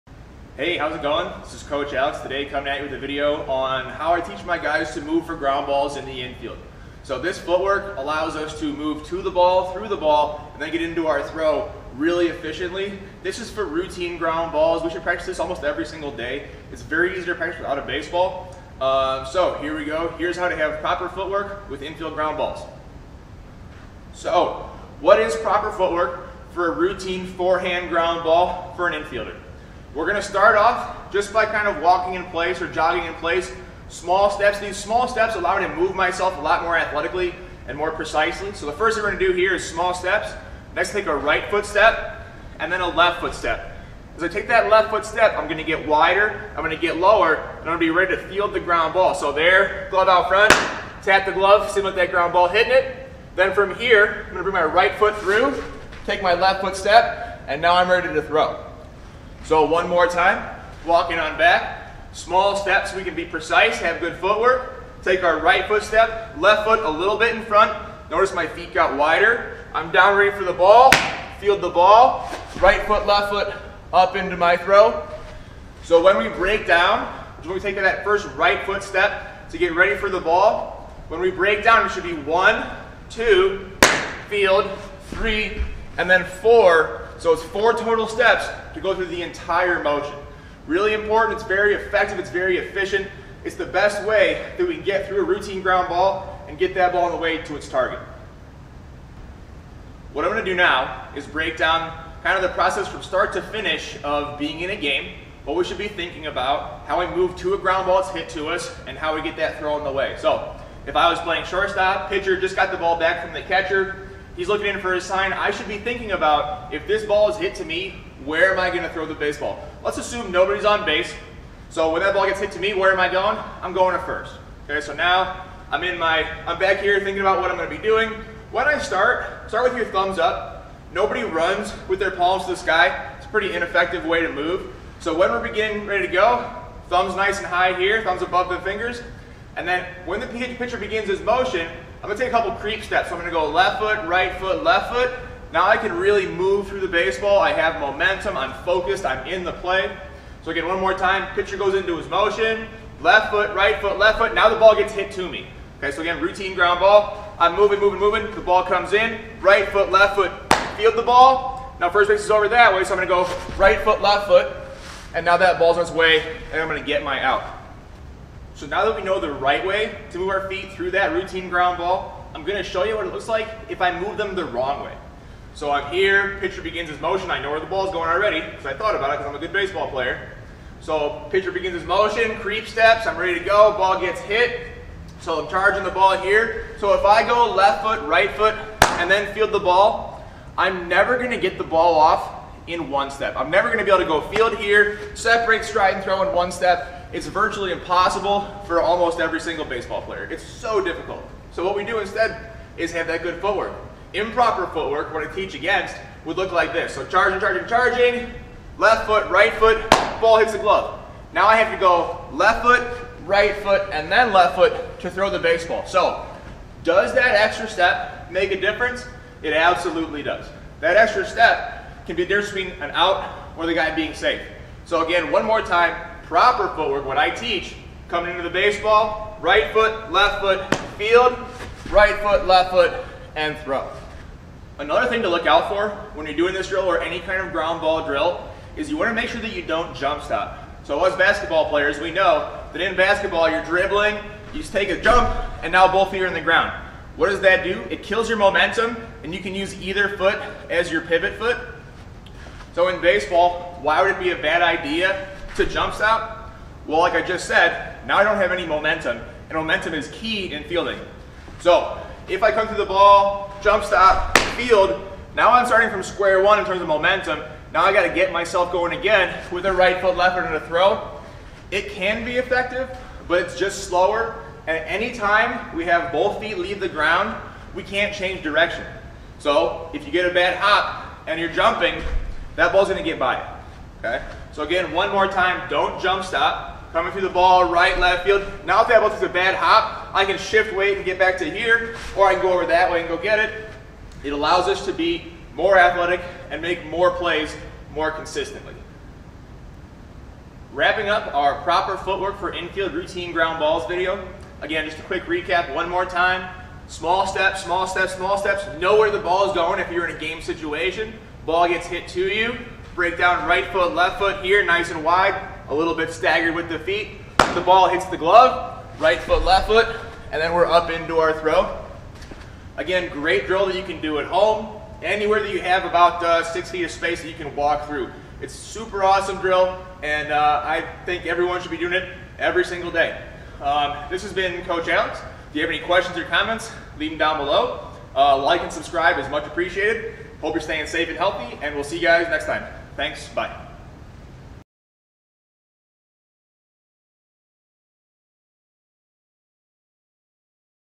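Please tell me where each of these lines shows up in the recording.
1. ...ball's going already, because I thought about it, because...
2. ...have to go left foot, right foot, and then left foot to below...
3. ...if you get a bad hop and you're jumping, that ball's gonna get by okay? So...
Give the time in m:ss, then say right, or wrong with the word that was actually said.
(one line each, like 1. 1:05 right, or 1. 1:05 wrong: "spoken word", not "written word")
1. 2:57 right
2. 3:31 wrong: "throw", not "below"
3. 4:39 right.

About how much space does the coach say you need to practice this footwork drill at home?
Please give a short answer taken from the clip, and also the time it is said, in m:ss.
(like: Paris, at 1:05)
6 feet, at 5:26.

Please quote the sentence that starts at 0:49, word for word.
So there, glove out front, tap the glove, simulate that ground ball hitting it.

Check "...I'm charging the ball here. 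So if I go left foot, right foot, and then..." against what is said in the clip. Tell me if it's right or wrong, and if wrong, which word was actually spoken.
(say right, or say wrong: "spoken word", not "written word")
right.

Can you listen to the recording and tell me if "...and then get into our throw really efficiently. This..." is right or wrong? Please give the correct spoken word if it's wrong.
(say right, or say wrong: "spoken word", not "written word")
right.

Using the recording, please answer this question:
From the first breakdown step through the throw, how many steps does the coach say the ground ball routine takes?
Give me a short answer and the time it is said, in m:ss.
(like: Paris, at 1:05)
4, at 1:27.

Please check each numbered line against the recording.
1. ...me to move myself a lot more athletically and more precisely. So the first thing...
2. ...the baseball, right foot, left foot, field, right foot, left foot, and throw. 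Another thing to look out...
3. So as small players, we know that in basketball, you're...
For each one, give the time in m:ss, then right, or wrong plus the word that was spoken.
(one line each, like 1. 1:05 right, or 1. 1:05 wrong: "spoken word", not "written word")
1. 0:35 right
2. 3:48 right
3. 4:00 wrong: "basketball", not "small".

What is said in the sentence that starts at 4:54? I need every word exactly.
It allows us to be more athletic and make more plays more consistently.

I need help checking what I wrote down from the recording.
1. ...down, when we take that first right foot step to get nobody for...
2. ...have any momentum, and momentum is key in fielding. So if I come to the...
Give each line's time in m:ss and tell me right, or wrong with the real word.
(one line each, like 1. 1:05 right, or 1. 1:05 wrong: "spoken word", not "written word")
1. 1:16 wrong: "ready", not "nobody"
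2. 4:18 right.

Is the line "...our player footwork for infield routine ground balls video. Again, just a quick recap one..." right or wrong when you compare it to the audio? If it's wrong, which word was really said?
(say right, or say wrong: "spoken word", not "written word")
wrong: "proper", not "player".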